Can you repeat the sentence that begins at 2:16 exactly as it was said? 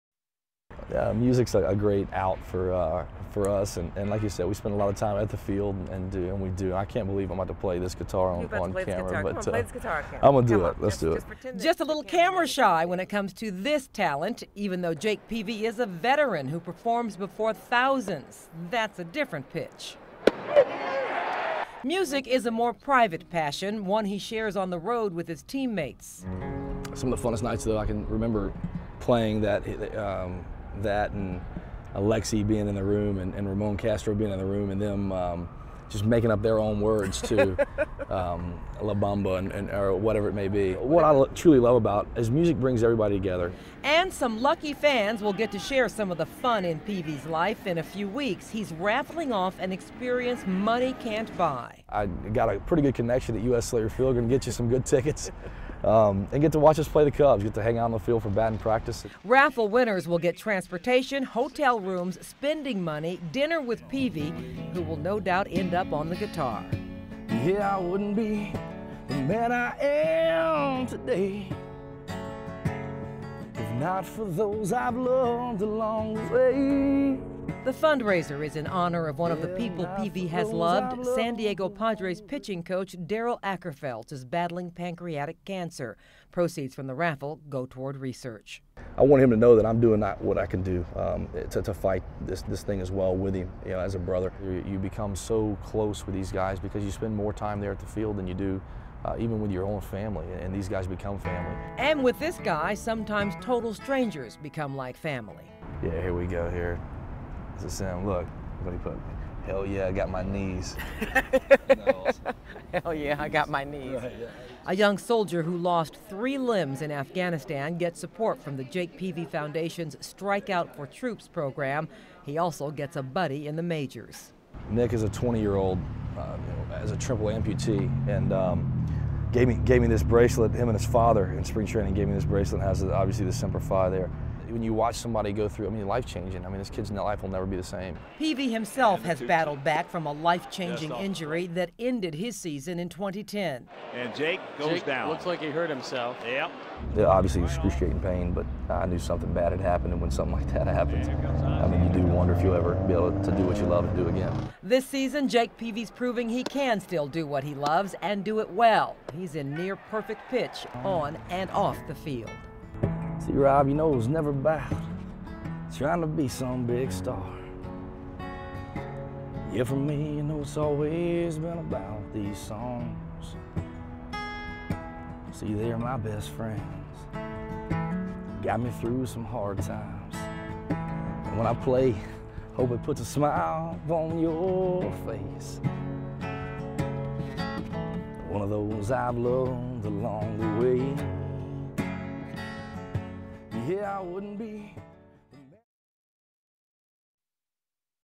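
I mean, this kid's life will never be the same.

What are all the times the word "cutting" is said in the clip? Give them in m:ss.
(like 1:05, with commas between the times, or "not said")
not said.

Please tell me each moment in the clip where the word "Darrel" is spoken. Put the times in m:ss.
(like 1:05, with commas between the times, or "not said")
1:23.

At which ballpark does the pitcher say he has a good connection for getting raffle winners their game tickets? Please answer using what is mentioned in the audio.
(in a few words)
U.S. Cellular Field.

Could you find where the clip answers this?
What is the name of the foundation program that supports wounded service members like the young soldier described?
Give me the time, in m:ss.
1:59.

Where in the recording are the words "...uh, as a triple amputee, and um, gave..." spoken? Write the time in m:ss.
2:06.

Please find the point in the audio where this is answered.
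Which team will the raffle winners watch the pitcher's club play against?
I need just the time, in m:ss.
0:57.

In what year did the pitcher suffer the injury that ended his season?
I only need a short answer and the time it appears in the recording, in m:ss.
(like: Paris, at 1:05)
2010, at 2:22.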